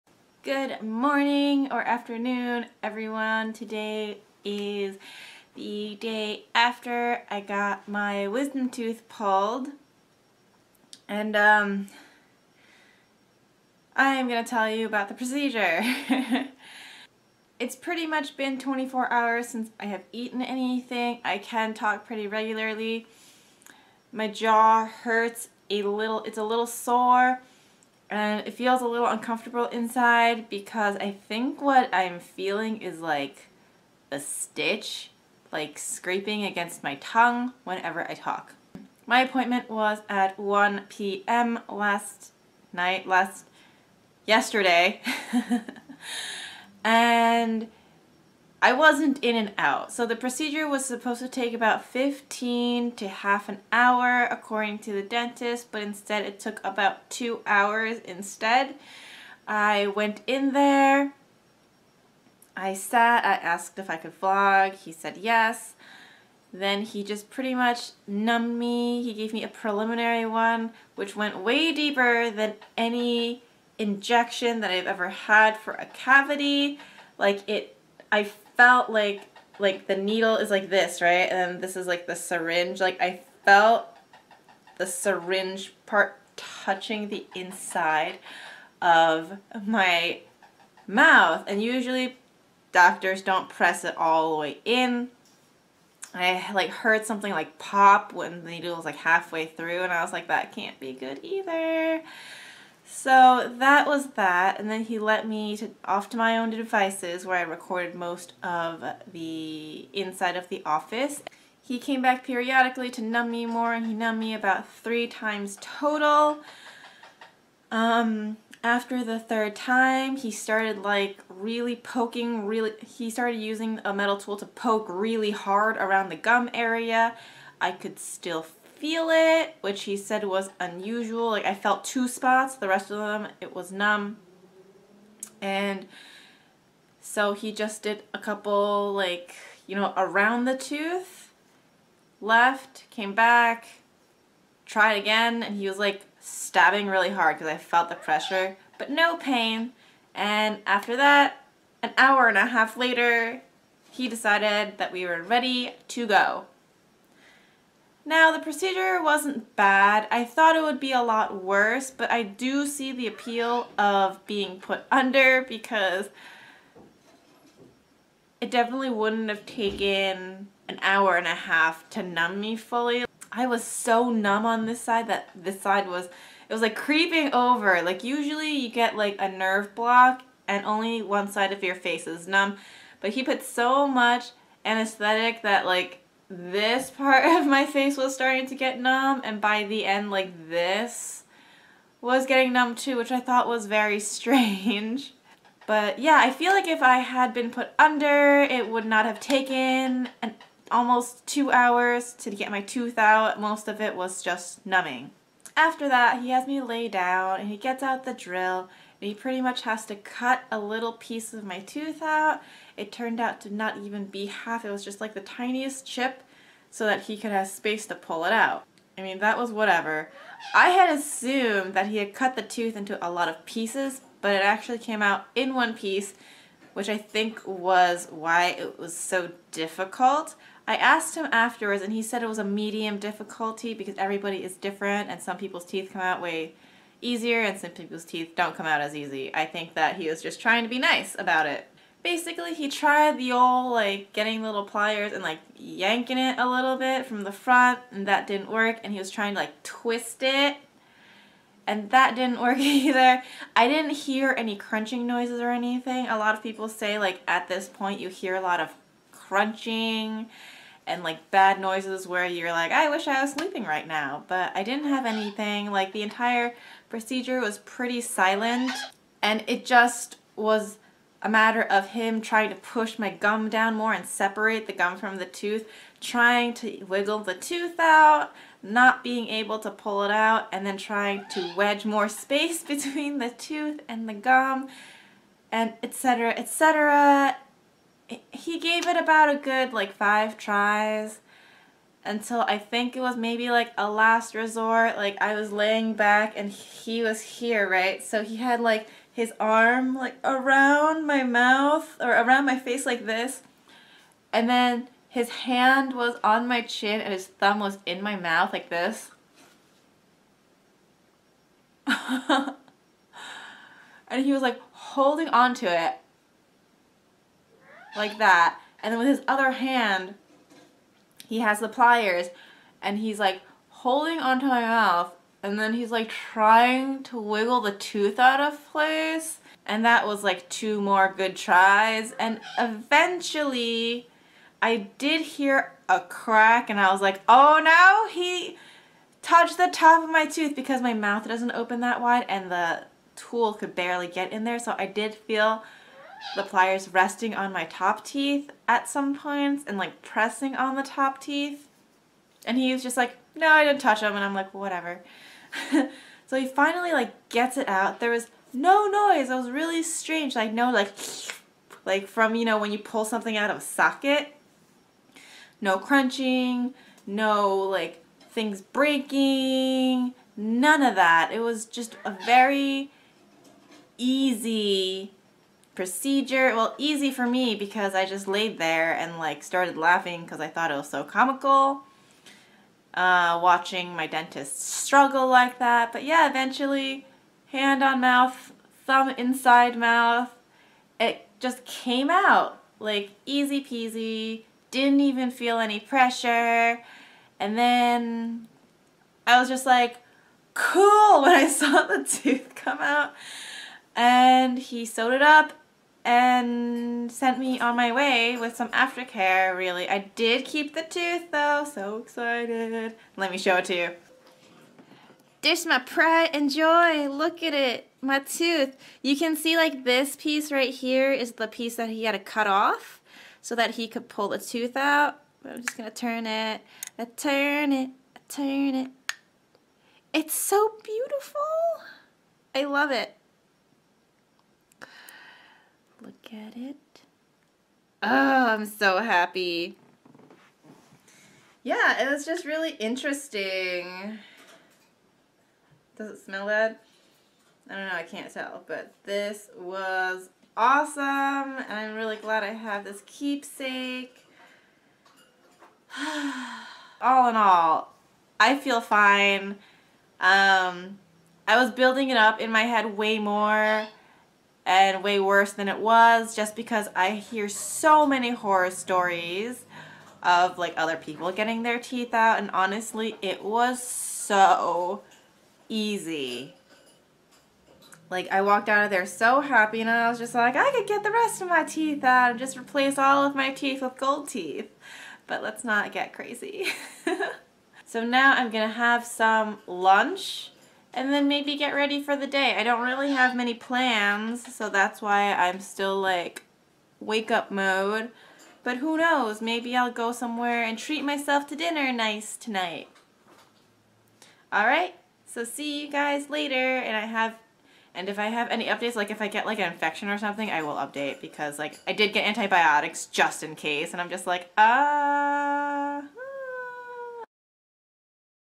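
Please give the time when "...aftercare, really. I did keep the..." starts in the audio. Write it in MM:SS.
06:48.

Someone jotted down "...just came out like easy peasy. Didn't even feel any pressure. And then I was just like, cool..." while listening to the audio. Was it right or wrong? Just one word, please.
right.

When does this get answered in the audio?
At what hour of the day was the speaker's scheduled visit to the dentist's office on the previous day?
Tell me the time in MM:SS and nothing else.
00:40.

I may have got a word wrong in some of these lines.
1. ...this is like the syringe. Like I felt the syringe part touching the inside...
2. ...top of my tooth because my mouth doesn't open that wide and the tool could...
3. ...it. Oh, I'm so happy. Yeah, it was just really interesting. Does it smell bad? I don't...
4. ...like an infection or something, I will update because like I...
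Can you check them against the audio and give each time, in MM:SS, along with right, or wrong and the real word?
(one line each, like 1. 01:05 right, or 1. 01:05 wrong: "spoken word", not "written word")
1. 01:21 right
2. 05:39 right
3. 07:16 right
4. 08:29 right.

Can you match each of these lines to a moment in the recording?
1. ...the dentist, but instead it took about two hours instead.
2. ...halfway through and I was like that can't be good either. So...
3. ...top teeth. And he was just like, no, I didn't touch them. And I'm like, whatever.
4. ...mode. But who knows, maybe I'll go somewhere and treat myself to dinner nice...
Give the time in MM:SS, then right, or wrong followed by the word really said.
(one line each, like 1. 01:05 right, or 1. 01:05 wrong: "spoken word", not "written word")
1. 00:54 right
2. 01:38 right
3. 05:50 right
4. 08:17 right.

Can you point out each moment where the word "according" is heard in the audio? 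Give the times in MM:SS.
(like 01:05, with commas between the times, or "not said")
00:54.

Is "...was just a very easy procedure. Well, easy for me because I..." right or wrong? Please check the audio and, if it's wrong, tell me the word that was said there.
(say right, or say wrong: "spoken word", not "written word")
right.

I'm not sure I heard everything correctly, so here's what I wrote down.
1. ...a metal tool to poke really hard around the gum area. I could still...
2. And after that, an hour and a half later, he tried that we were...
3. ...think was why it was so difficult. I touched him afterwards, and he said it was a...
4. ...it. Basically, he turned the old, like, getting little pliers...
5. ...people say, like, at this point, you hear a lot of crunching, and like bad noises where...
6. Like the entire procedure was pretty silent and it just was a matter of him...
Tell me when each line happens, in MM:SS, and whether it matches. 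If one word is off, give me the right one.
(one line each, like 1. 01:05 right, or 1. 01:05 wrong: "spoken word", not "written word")
1. 02:03 right
2. 02:30 wrong: "decided", not "tried"
3. 03:46 wrong: "asked", not "touched"
4. 04:01 wrong: "tried", not "turned"
5. 04:16 right
6. 04:25 right.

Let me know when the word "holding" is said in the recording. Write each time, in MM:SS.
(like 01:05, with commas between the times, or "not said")
05:14, 05:23.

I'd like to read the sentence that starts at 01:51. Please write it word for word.
He came back periodically to numb me more, and he numbed me about three times total.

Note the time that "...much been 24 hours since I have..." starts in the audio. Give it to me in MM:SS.
00:18.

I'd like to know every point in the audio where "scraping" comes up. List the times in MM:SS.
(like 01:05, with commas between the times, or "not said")
00:35.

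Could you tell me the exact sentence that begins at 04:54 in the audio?
Like I was laying back and he was here, right?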